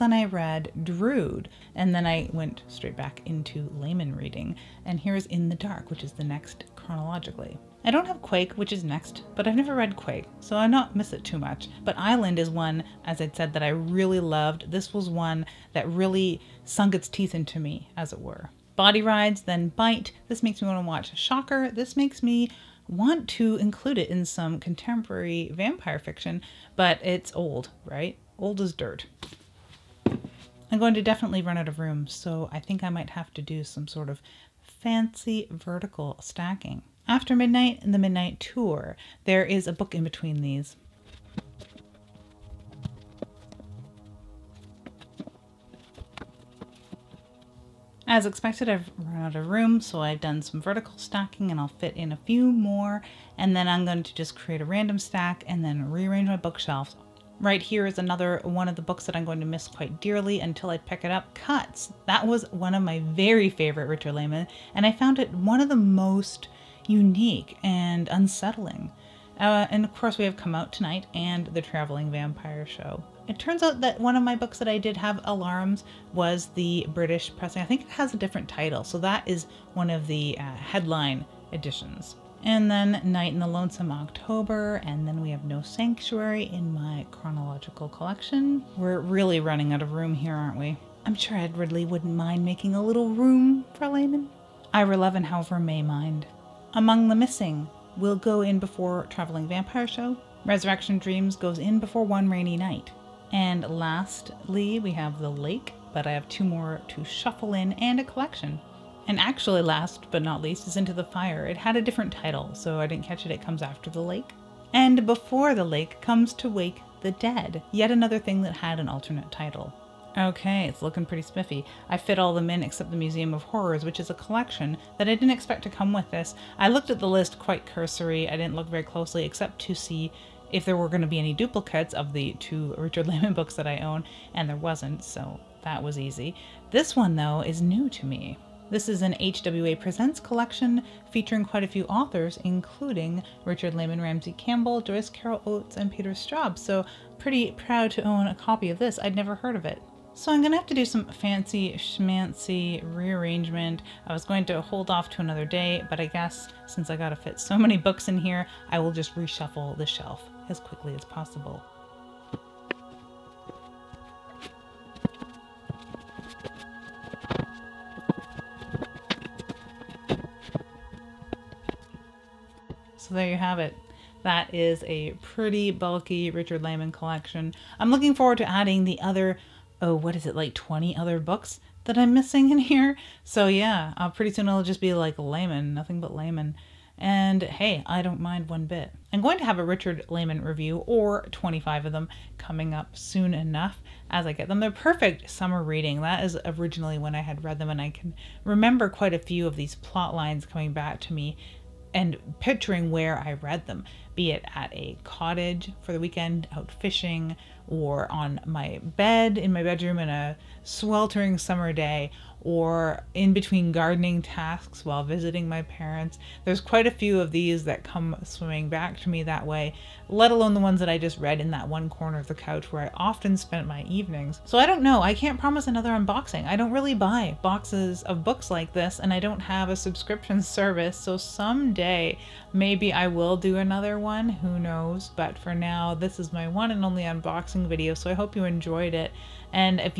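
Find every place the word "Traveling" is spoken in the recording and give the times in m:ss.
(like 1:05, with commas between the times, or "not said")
1:11, 1:39.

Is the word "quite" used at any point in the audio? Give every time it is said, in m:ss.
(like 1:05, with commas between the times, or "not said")
0:59, 2:07, 2:21, 3:18, 3:36.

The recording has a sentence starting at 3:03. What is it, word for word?
So yeah, uh, pretty soon i will just be like Laymon, nothing but Laymon.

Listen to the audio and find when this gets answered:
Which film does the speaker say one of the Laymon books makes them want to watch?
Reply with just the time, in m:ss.
0:21.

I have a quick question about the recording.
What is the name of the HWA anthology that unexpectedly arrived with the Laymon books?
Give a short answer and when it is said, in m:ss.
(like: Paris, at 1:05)
The Museum of Horrors, at 2:02.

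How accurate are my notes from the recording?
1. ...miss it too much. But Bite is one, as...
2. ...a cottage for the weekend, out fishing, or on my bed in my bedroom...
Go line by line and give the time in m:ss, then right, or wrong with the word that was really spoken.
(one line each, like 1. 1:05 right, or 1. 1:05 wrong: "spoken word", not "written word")
1. 0:10 wrong: "Island", not "Bite"
2. 3:24 right.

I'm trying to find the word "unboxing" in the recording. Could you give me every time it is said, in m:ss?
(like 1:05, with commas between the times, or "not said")
3:45, 3:57.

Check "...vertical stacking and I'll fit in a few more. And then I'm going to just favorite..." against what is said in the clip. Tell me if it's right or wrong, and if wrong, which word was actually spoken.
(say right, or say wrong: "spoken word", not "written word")
wrong: "create", not "favorite".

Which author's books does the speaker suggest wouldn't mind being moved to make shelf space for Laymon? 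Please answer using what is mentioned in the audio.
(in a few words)
Edward Lee.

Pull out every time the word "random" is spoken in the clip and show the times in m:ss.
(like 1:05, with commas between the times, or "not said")
0:54.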